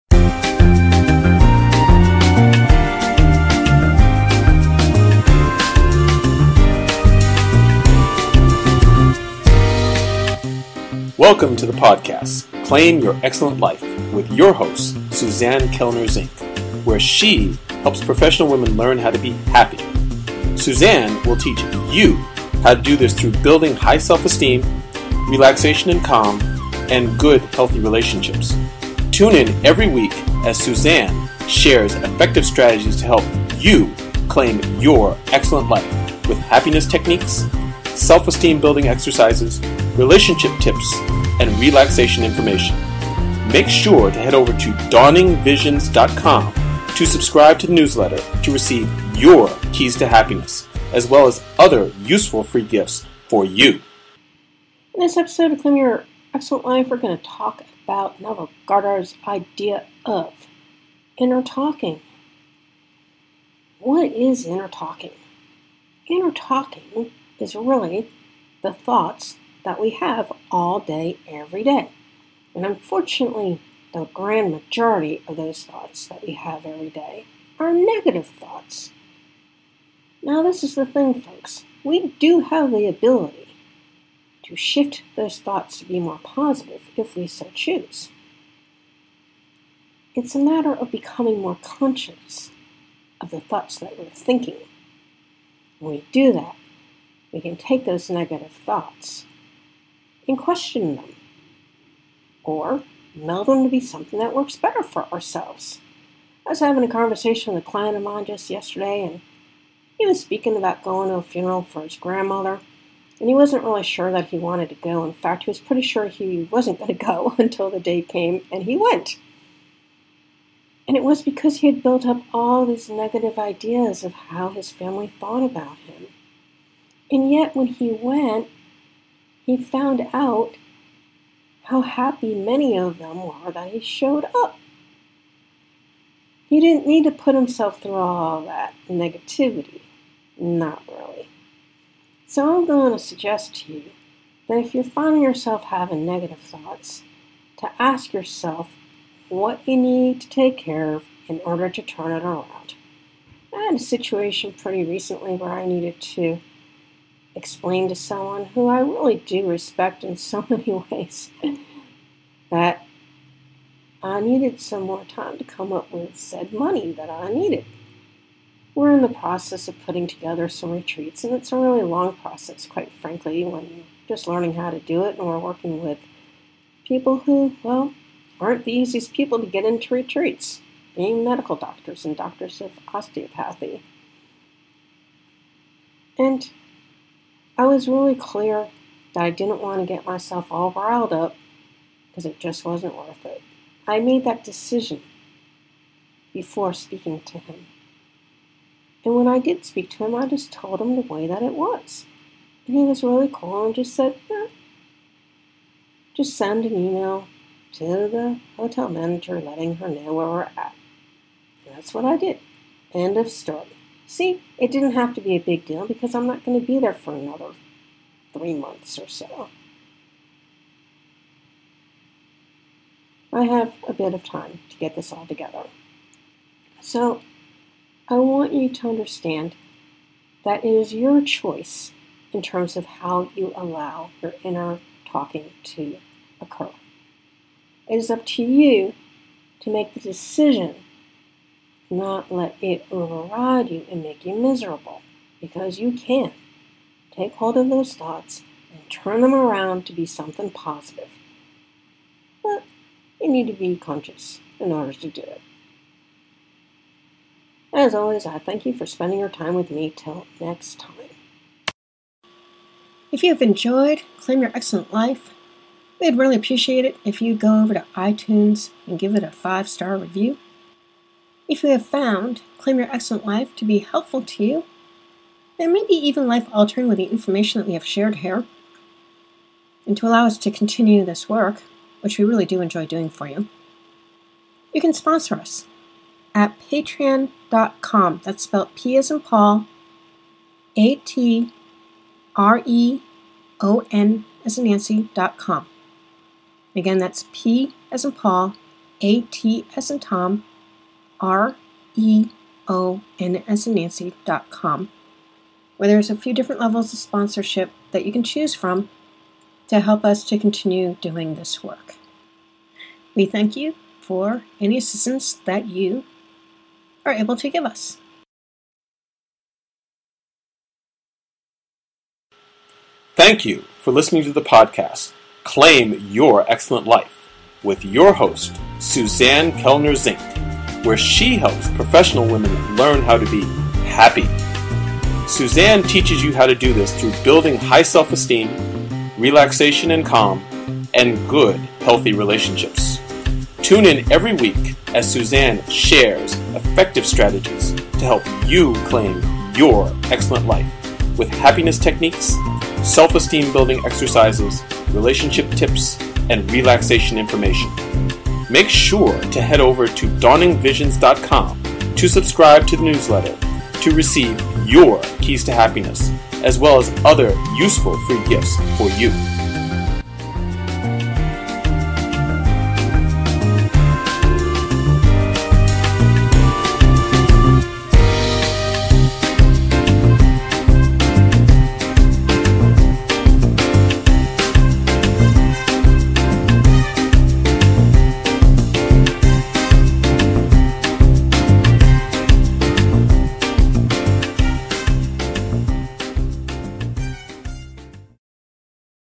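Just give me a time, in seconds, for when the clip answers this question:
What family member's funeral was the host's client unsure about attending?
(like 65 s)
111 s.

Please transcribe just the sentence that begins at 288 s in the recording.
That's spelled P as in Paul, A T R E O N as in Nancy.com.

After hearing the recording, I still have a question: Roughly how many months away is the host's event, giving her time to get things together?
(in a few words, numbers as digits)
3 months.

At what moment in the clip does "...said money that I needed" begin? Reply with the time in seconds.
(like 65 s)
166 s.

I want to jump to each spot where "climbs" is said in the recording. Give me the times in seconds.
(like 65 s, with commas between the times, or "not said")
not said.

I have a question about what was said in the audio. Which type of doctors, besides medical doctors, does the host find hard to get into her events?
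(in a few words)
Doctors of osteopathy.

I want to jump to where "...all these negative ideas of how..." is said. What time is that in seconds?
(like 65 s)
122 s.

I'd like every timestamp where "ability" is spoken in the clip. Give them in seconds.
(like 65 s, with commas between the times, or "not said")
82 s.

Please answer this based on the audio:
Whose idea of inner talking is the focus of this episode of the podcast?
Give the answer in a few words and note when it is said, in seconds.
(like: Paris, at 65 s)
Neville Goddard, at 58 s.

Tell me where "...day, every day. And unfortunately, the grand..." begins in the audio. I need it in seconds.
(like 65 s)
70 s.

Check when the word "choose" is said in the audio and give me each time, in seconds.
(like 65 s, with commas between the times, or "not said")
87 s, 308 s.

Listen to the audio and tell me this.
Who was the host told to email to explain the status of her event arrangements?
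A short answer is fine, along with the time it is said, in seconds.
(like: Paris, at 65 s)
The hotel manager, at 208 s.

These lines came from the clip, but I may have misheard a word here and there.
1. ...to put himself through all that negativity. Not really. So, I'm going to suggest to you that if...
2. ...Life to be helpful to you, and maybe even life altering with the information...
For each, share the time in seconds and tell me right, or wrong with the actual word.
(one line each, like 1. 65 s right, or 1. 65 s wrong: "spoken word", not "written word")
1. 137 s right
2. 273 s right.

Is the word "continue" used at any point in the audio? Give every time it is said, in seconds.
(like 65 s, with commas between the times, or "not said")
280 s, 310 s.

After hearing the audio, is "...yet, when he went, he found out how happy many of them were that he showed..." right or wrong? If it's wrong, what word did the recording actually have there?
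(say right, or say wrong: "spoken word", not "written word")
right.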